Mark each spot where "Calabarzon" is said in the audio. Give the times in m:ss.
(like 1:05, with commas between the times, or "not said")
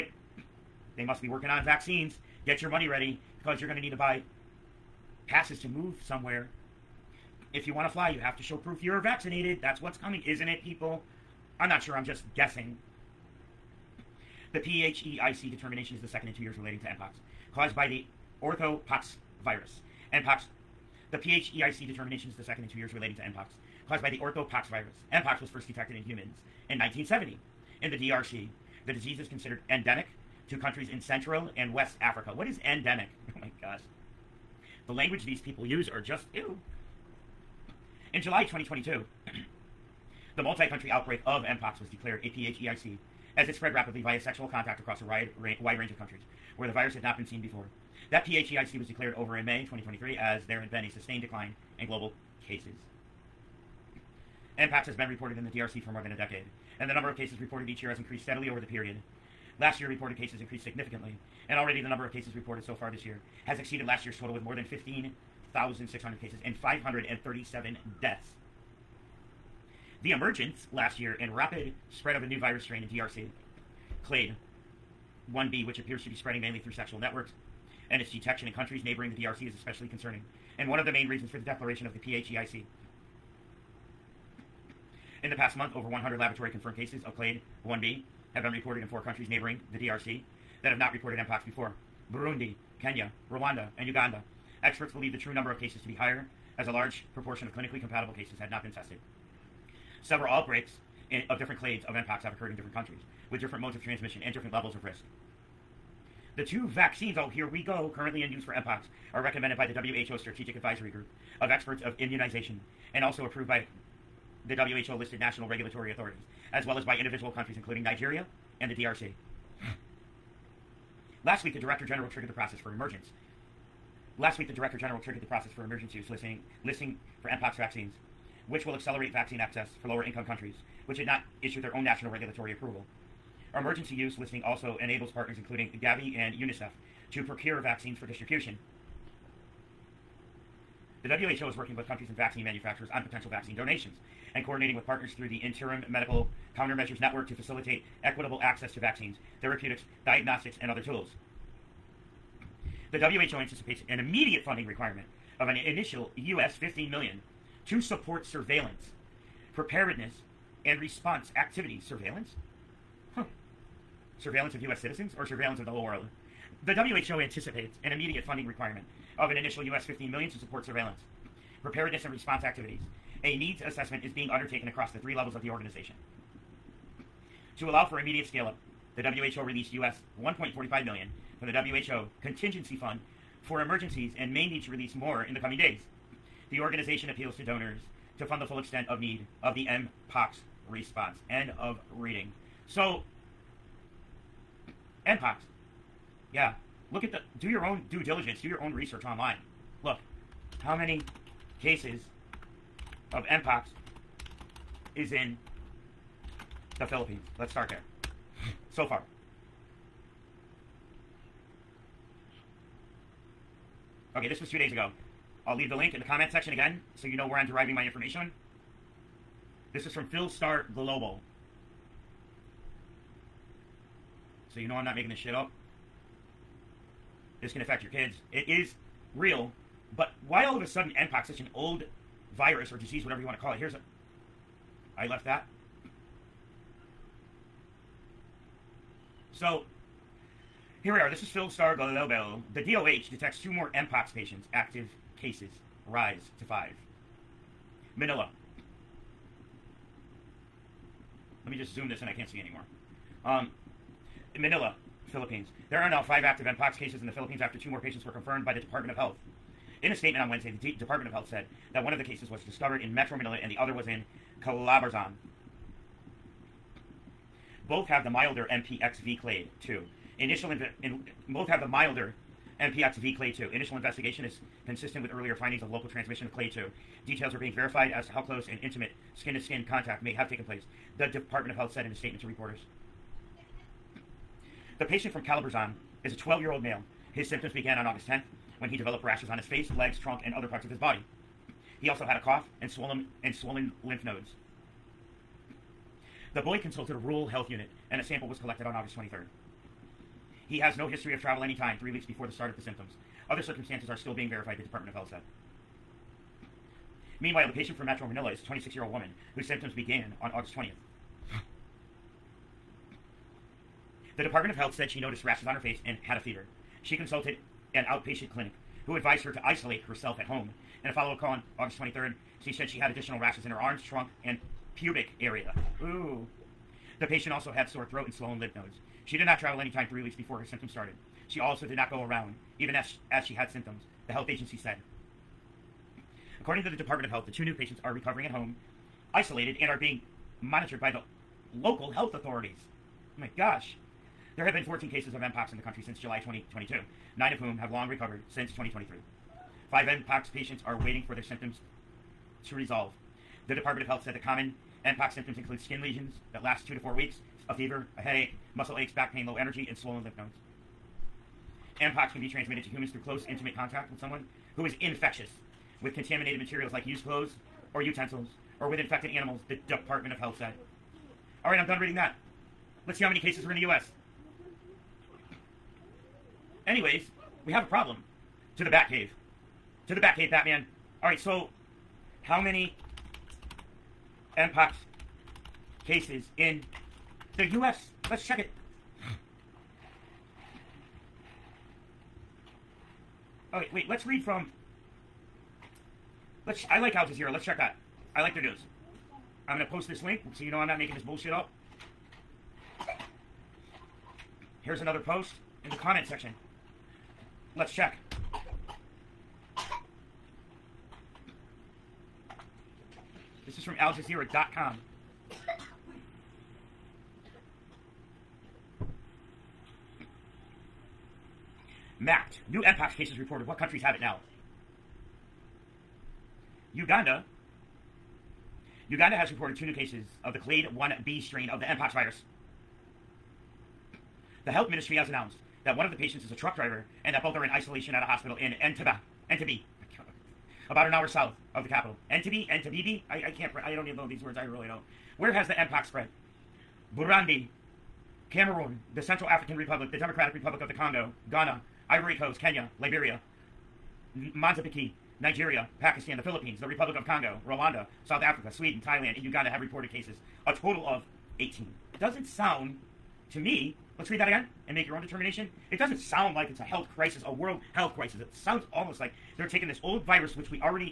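4:24, 4:45.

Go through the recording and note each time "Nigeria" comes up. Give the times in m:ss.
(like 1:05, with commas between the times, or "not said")
1:57, 7:35.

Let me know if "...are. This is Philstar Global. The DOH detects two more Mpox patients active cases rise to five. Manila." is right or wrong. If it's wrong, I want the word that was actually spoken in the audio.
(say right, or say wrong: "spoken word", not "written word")
right.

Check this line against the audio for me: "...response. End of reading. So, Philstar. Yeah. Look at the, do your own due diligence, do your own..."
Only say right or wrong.
wrong.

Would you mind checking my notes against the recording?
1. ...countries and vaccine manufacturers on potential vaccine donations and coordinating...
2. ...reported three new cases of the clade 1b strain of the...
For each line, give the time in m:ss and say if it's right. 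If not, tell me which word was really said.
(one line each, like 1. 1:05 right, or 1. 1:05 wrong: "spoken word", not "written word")
1. 2:21 right
2. 7:09 wrong: "two", not "three".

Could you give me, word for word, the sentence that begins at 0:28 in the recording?
The disease is considered endemic to countries in Central and West Africa.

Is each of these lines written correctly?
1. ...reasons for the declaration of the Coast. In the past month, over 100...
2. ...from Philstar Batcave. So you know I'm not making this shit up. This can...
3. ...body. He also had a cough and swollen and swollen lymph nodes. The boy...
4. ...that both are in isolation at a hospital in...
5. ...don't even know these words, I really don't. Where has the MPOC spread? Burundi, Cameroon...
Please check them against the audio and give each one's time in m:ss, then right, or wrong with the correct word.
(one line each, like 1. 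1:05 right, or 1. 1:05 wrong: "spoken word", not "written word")
1. 1:21 wrong: "PHEIC", not "Coast"
2. 3:39 wrong: "Global", not "Batcave"
3. 4:50 right
4. 7:17 right
5. 7:23 right.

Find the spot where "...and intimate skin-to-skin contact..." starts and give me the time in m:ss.
4:38.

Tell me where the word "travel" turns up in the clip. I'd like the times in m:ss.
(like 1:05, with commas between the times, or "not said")
5:01, 5:29.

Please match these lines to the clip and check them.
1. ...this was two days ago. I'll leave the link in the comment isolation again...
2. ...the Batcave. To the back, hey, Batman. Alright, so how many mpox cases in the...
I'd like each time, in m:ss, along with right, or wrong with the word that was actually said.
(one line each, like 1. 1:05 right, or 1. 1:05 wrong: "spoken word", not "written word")
1. 3:34 wrong: "section", not "isolation"
2. 6:18 right.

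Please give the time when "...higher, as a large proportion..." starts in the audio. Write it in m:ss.
1:35.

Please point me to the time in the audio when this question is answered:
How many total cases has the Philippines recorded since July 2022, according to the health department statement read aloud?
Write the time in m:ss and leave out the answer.
5:44.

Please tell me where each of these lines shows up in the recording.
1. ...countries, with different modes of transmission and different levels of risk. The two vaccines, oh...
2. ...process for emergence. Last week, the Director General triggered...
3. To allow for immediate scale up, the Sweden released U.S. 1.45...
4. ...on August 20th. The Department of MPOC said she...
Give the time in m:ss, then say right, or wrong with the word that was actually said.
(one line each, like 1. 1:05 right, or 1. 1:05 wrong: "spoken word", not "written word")
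1. 1:42 right
2. 2:02 right
3. 2:57 wrong: "WHO", not "Sweden"
4. 5:10 wrong: "Health", not "MPOC".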